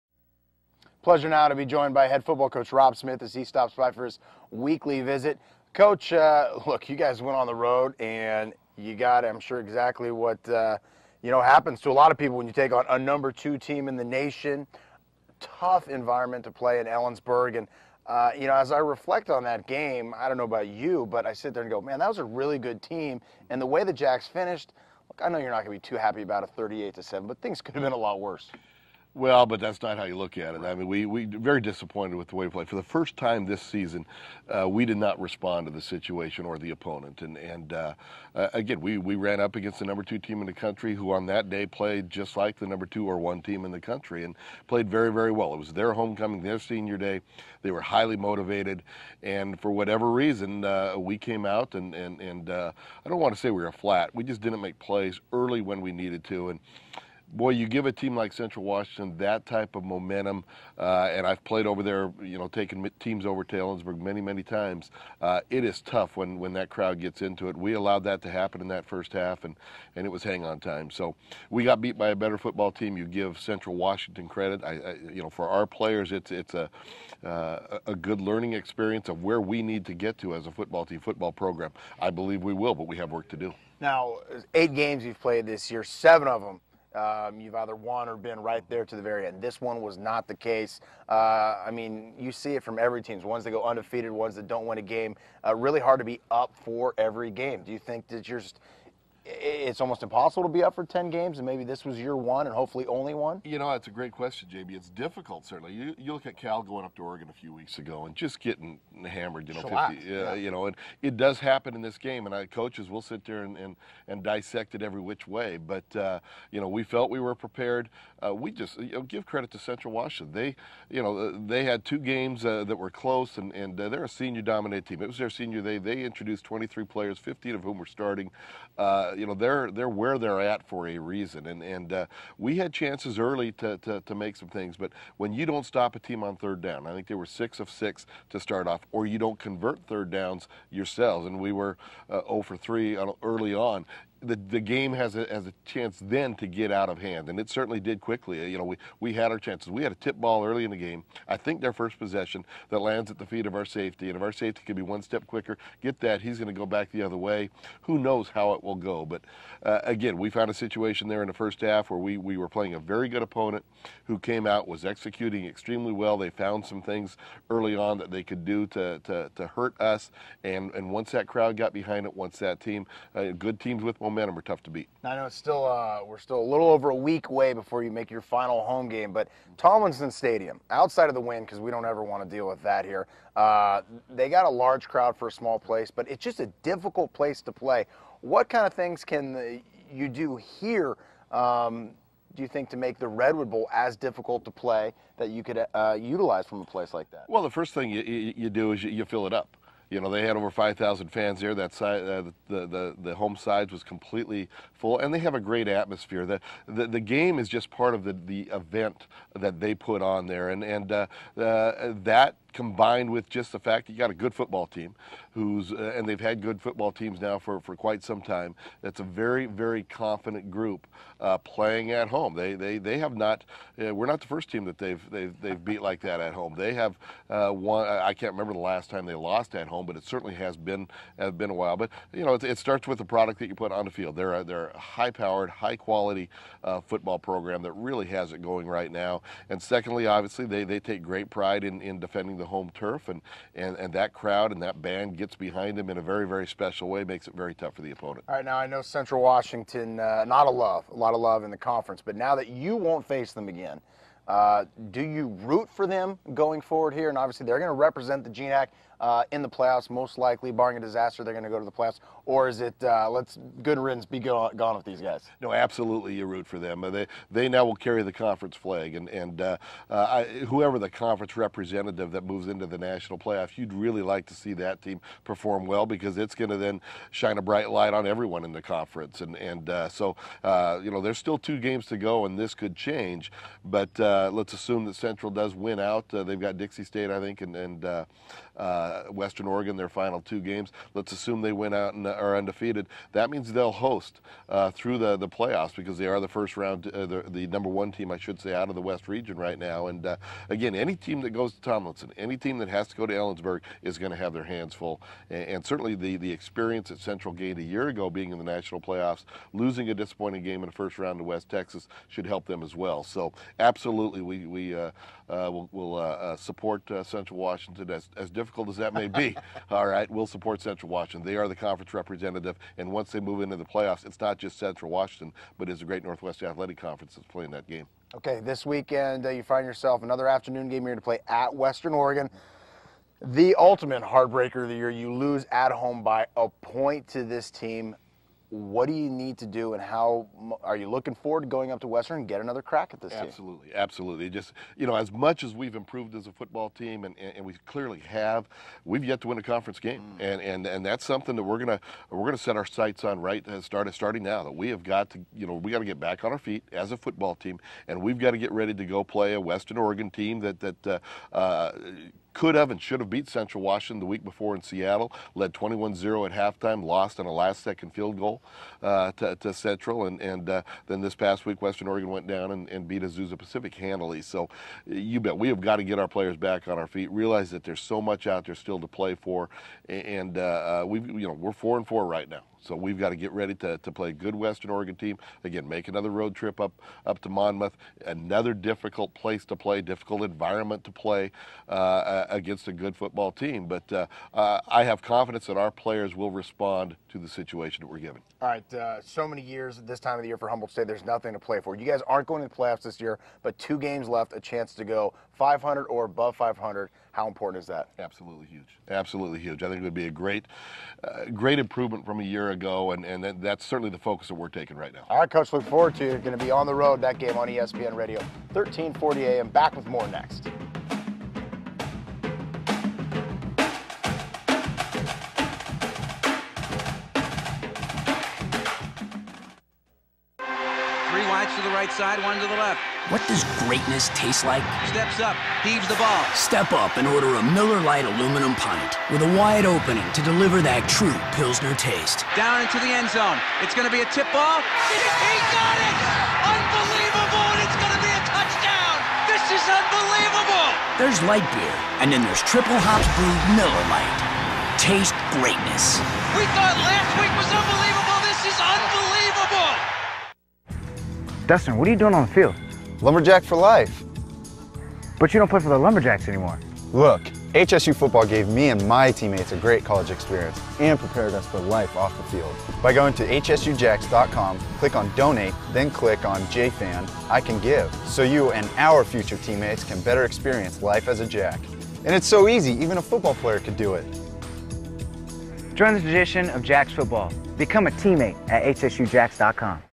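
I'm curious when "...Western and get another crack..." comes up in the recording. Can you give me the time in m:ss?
5:41.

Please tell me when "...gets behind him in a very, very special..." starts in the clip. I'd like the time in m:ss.
4:05.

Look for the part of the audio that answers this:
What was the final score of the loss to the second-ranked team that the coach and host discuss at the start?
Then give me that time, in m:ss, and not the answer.
0:26.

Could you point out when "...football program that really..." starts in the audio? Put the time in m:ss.
3:56.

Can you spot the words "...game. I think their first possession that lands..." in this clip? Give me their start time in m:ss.
2:30.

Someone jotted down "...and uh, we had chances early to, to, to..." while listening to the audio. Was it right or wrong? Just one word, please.
right.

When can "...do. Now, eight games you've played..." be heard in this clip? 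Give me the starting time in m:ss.
1:23.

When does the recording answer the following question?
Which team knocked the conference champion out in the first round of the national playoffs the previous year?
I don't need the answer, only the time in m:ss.
5:11.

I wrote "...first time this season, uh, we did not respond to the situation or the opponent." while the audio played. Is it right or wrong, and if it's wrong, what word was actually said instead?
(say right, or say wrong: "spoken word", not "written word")
right.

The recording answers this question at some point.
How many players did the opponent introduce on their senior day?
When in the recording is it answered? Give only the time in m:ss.
2:06.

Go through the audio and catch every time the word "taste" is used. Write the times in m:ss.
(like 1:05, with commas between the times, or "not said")
7:14, 7:21, 7:34.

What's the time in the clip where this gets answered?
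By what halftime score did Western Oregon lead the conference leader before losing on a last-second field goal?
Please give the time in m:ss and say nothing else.
6:05.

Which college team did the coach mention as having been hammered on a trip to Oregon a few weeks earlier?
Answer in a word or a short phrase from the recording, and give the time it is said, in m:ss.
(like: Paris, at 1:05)
Cal, at 1:46.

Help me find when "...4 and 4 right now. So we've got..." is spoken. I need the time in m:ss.
6:21.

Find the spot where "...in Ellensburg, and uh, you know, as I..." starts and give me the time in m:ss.
0:16.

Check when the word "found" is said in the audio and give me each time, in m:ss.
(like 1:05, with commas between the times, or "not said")
2:40, 2:46.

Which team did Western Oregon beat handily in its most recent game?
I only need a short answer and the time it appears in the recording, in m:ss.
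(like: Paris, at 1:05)
Azusa Pacific, at 6:13.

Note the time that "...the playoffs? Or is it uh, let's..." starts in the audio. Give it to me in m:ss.
4:21.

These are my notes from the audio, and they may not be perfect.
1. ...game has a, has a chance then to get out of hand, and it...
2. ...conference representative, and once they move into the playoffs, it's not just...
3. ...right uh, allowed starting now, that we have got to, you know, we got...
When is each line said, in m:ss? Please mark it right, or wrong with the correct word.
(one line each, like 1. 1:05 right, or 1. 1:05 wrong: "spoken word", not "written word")
1. 2:24 right
2. 5:21 right
3. 5:53 wrong: "started", not "allowed".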